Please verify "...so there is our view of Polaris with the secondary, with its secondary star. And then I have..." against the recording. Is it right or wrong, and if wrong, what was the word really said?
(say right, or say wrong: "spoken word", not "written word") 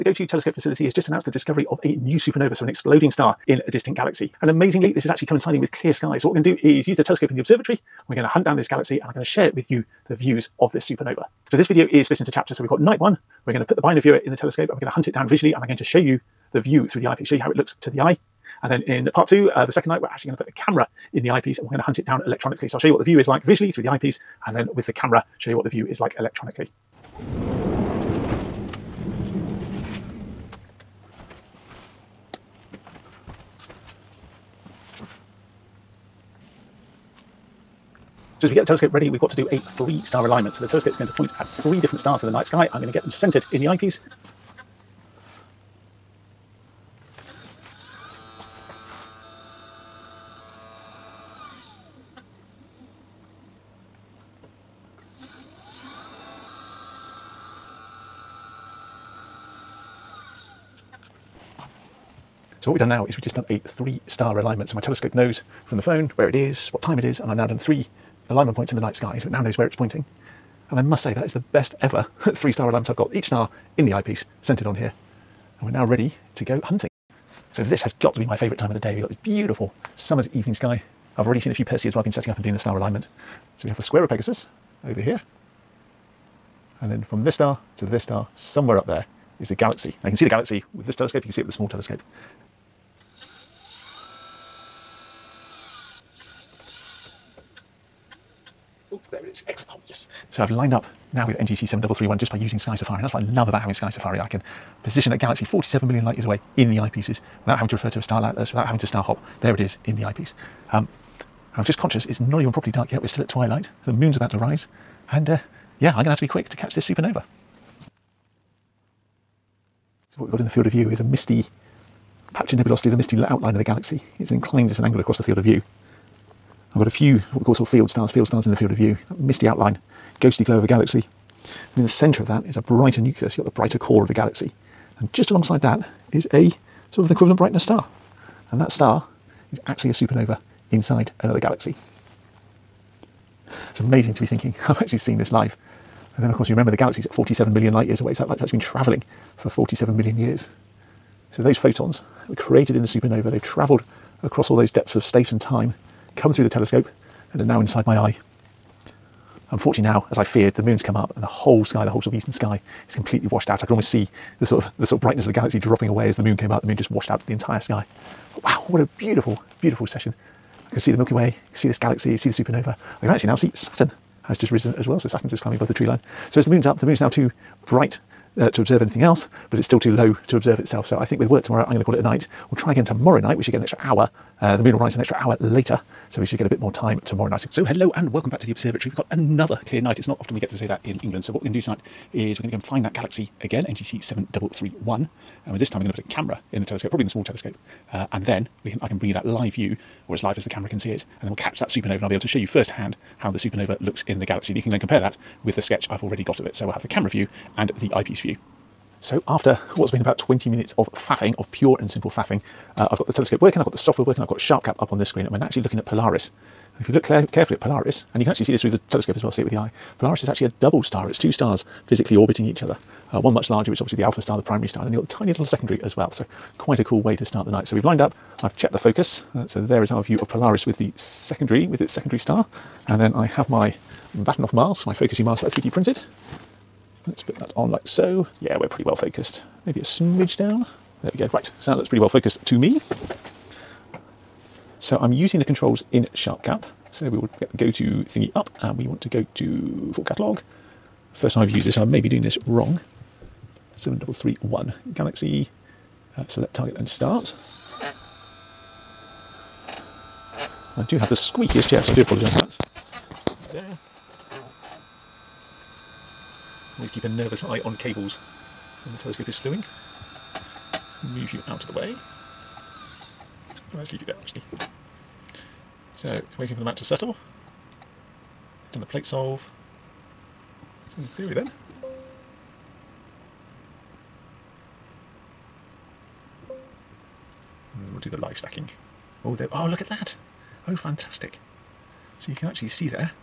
right.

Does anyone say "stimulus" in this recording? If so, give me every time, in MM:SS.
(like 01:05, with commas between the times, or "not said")
not said.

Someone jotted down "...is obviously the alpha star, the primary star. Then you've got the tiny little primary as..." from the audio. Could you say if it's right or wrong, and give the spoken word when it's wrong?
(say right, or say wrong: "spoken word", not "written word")
wrong: "secondary", not "primary".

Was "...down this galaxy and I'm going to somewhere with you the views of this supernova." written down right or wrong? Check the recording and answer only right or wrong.
wrong.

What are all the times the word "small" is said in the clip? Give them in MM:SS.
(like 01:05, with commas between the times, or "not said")
01:31, 03:17.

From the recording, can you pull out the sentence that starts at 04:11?
First time I've used this, I may be doing this wrong.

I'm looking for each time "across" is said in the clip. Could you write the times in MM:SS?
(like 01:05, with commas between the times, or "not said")
02:04, 02:34.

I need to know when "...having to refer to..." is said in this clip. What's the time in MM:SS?
01:47.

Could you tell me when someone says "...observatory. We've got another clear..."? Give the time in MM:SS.
03:08.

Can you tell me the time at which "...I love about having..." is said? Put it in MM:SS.
01:43.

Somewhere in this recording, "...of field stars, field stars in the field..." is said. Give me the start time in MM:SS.
02:07.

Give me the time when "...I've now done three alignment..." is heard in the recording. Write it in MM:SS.
01:07.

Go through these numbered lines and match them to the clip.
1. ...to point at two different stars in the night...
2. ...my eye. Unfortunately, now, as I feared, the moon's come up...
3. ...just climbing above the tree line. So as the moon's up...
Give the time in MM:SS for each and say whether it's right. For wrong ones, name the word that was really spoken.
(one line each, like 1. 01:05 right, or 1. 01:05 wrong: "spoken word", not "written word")
1. 00:41 wrong: "three", not "two"
2. 02:37 right
3. 02:55 right.